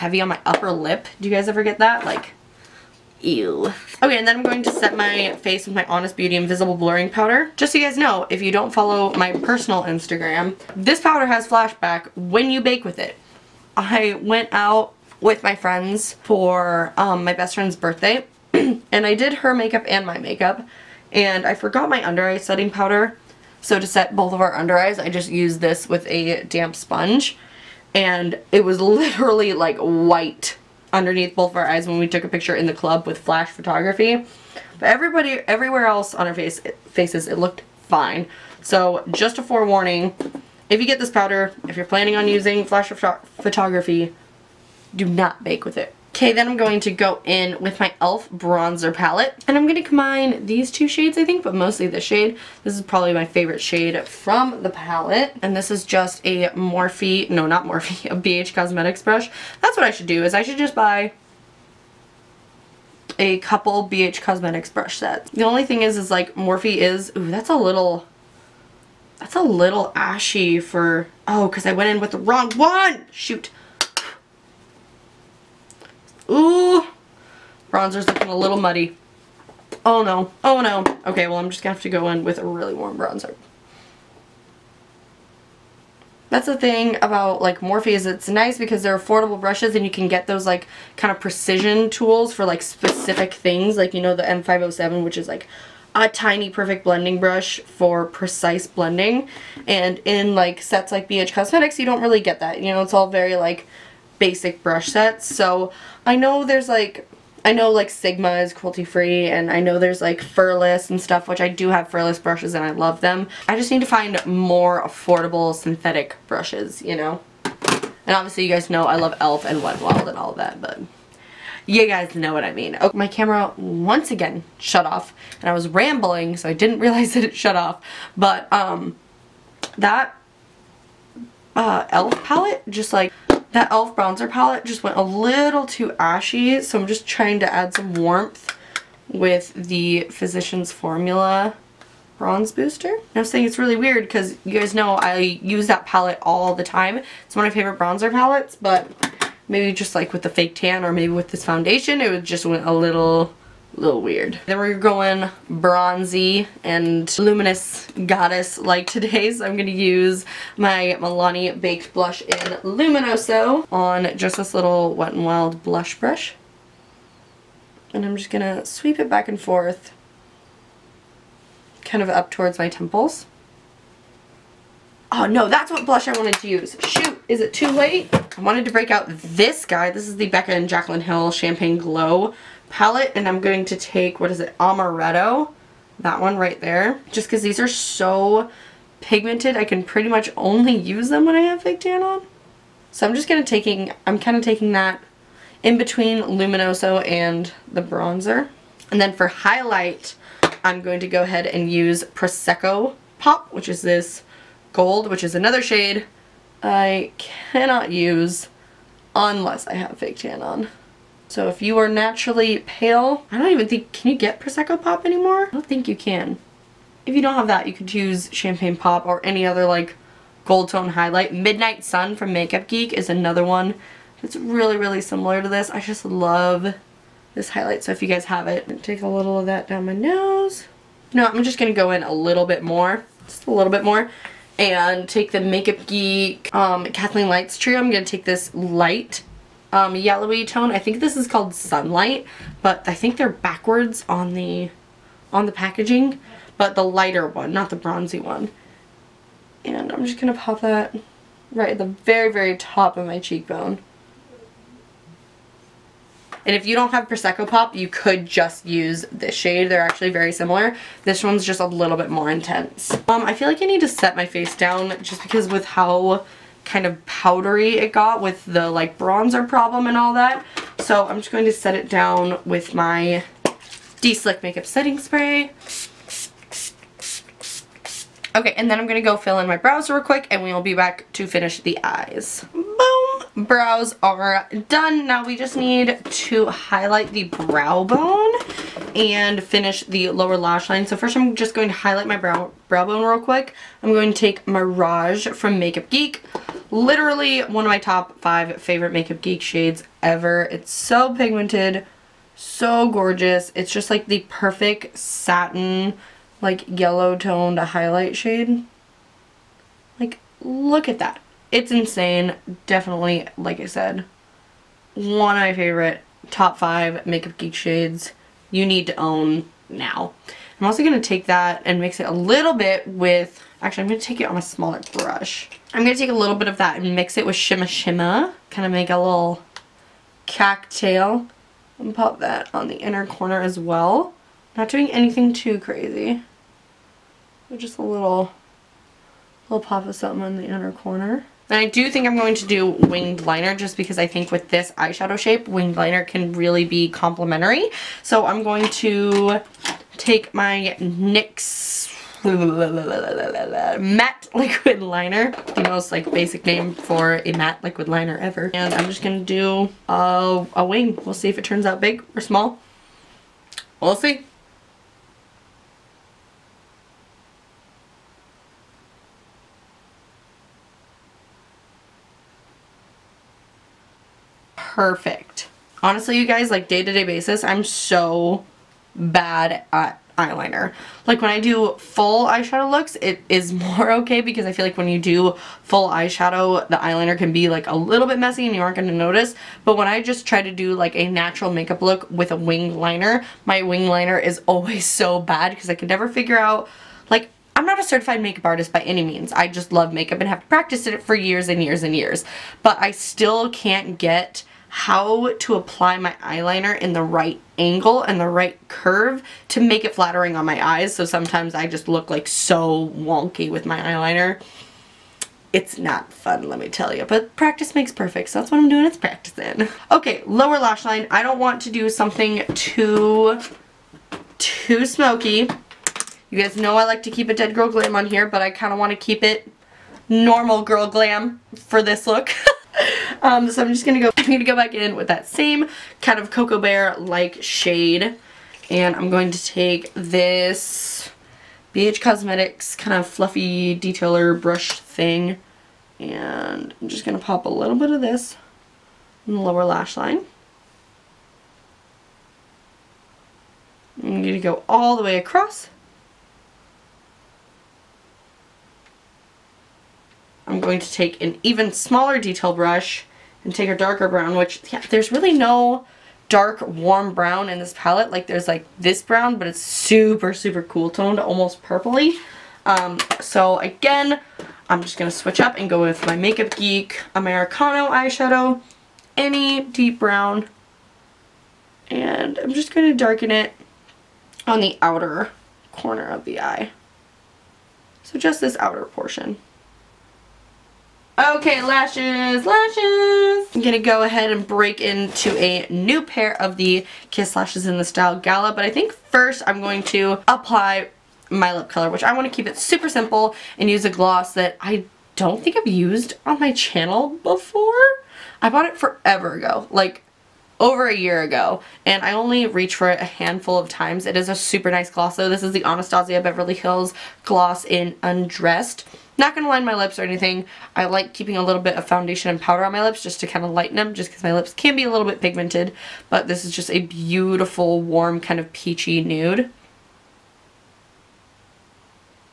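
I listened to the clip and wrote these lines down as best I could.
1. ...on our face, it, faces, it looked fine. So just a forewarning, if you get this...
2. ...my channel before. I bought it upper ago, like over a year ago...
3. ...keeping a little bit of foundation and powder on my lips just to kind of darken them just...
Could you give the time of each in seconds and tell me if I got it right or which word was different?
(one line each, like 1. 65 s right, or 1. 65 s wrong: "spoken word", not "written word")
1. 36 s right
2. 506 s wrong: "forever", not "upper"
3. 521 s wrong: "lighten", not "darken".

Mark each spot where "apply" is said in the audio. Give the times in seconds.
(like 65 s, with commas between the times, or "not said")
405 s, 500 s.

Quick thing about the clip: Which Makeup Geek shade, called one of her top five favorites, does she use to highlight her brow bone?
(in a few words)
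Mirage.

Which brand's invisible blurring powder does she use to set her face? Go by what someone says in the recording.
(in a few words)
Honest Beauty.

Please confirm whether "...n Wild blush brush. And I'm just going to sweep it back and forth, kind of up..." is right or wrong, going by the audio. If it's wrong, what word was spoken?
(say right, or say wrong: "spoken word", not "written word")
right.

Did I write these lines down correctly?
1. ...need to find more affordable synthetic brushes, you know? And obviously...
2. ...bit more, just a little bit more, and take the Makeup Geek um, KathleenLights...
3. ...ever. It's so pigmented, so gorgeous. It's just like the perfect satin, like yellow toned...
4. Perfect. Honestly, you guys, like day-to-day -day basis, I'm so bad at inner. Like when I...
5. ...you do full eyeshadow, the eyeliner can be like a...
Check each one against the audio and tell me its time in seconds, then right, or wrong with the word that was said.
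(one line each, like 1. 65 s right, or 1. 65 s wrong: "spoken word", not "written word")
1. 113 s right
2. 232 s right
3. 300 s right
4. 374 s wrong: "eyeliner", not "inner"
5. 384 s right.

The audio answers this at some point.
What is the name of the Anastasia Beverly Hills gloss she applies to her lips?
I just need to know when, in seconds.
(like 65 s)
518 s.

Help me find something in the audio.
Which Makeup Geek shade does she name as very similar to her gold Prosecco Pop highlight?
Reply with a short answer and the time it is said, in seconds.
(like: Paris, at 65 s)
Midnight Sun, at 221 s.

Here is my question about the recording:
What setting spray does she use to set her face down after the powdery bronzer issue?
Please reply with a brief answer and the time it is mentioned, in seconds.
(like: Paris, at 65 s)
De-Slick, at 274 s.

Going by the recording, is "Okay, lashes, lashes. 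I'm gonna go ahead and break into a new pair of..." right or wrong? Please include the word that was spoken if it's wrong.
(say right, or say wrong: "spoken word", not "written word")
right.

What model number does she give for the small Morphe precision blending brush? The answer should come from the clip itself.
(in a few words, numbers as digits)
M507.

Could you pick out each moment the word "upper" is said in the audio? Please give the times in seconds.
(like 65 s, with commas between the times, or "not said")
0 s.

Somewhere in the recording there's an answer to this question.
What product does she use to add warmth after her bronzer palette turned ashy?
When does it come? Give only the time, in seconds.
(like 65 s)
140 s.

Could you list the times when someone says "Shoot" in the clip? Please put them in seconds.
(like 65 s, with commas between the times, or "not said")
73 s, 176 s.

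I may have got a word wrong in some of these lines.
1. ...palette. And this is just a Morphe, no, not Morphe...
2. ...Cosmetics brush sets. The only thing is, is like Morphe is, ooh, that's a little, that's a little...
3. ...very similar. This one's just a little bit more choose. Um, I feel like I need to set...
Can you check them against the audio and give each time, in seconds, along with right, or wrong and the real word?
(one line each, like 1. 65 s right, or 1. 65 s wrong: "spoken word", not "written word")
1. 54 s right
2. 64 s right
3. 260 s wrong: "intense", not "choose".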